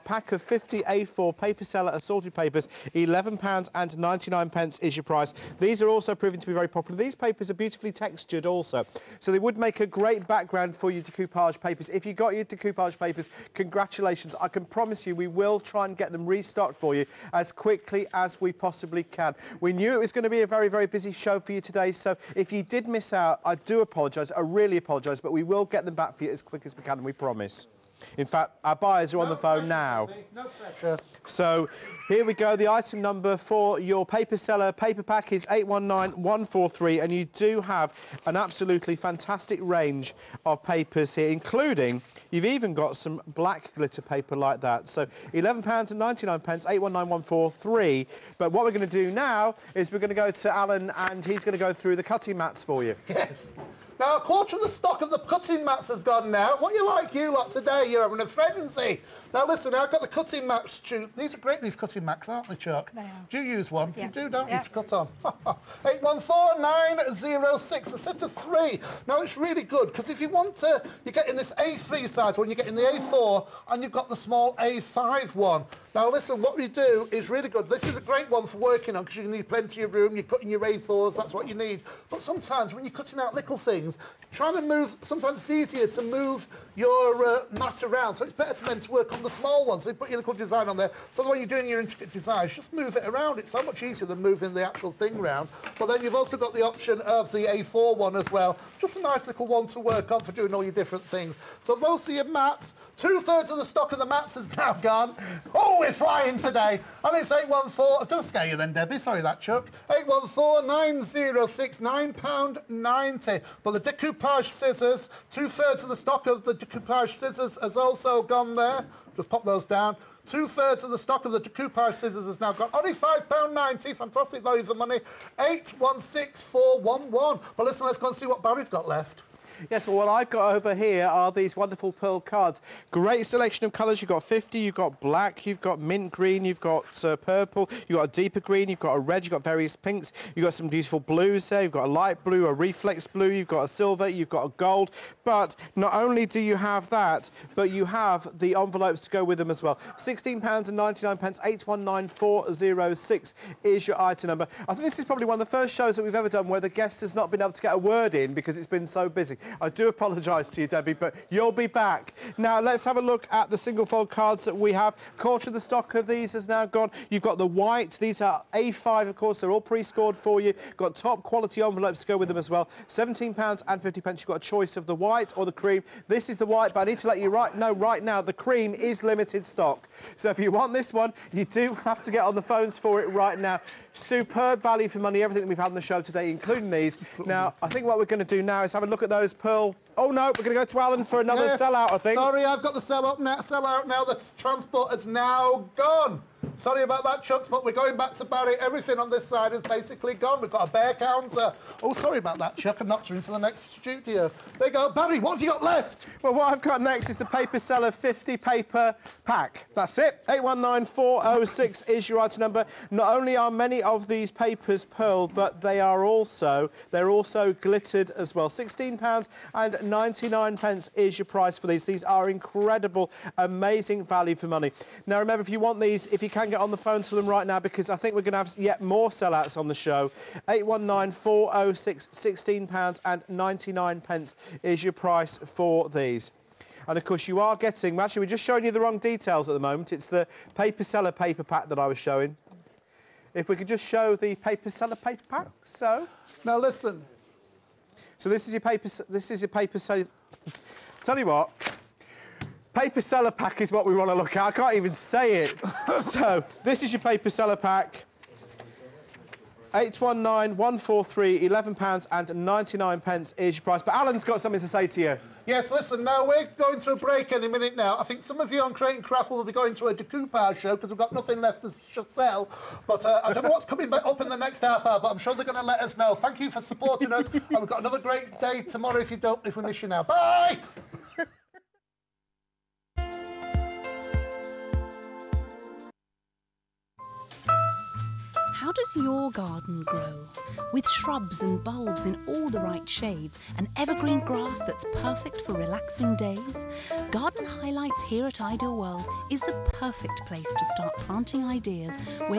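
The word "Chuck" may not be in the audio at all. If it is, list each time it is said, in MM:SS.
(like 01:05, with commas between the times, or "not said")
01:02, 01:49, 03:17, 03:22.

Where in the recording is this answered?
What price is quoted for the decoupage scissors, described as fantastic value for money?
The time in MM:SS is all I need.
02:02.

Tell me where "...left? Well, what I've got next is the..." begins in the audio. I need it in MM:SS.
03:25.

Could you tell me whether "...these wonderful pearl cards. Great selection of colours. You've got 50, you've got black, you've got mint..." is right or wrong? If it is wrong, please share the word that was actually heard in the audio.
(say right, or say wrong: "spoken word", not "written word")
right.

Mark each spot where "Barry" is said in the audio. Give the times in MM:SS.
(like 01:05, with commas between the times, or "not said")
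02:08, 03:18, 03:24.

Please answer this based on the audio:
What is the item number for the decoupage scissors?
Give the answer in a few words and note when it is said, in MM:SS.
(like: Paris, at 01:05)
816411, at 02:05.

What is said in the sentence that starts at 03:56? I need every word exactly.
And of course, you are getting, actually, we're just showing you the wrong details at the moment.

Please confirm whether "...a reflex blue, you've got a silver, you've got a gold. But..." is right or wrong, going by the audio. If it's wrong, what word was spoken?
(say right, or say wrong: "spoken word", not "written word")
right.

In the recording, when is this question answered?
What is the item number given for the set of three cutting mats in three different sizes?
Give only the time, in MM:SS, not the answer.
01:05.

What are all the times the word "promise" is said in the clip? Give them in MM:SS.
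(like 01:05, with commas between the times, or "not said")
00:14, 00:27.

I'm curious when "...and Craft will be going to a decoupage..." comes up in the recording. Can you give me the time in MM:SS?
04:28.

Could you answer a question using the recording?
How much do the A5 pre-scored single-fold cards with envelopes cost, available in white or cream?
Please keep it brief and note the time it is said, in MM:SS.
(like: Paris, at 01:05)
£17.50, at 02:52.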